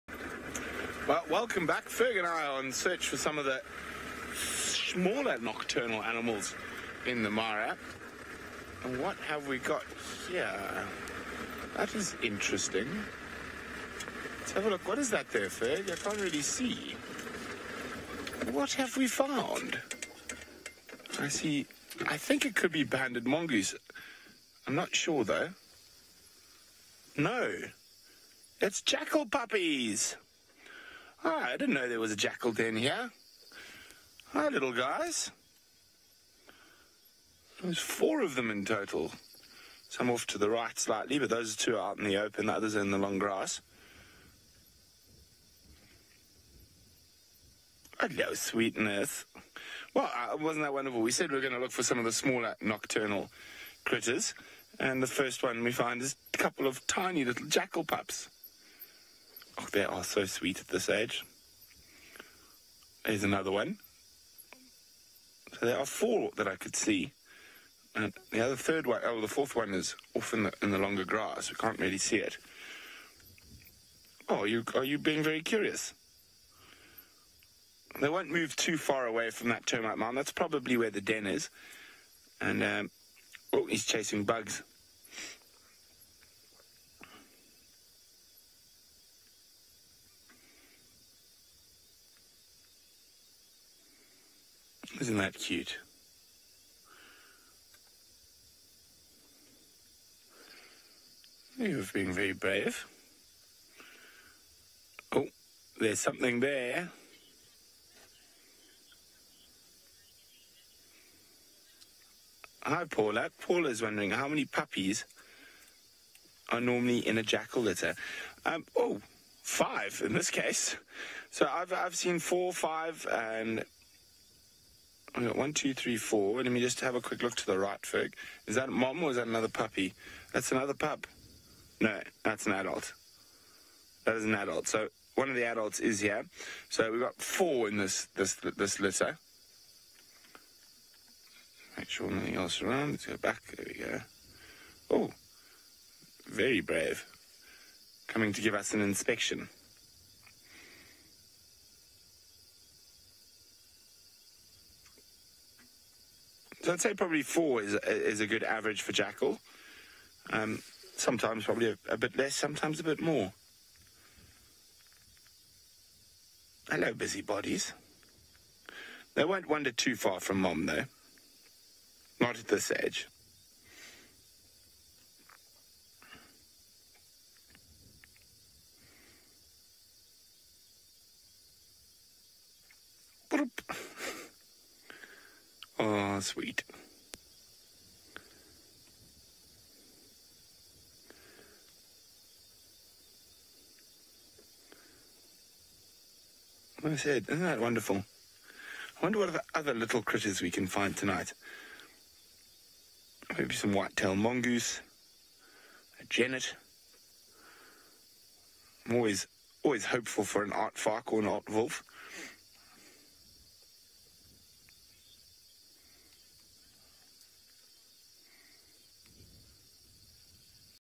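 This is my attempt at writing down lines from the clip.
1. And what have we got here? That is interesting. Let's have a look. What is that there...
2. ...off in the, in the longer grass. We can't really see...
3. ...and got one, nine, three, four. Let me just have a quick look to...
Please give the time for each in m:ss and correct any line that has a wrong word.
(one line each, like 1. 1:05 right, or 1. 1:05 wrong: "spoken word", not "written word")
1. 0:08 right
2. 1:10 right
3. 2:03 wrong: "two", not "nine".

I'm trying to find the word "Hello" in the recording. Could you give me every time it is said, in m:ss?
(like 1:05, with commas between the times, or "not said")
0:47, 2:46.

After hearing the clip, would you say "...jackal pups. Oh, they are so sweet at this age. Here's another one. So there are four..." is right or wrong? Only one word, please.
right.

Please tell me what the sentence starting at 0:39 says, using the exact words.
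Some off to the right slightly, but those two are out in the open, the others in the long grass.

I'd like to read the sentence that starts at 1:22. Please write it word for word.
And, um, oh, he's chasing bugs.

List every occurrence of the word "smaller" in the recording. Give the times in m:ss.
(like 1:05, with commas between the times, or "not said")
0:04, 0:52.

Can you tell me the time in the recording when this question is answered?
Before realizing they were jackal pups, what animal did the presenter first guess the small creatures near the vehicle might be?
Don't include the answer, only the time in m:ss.
0:22.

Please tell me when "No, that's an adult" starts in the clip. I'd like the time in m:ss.
2:11.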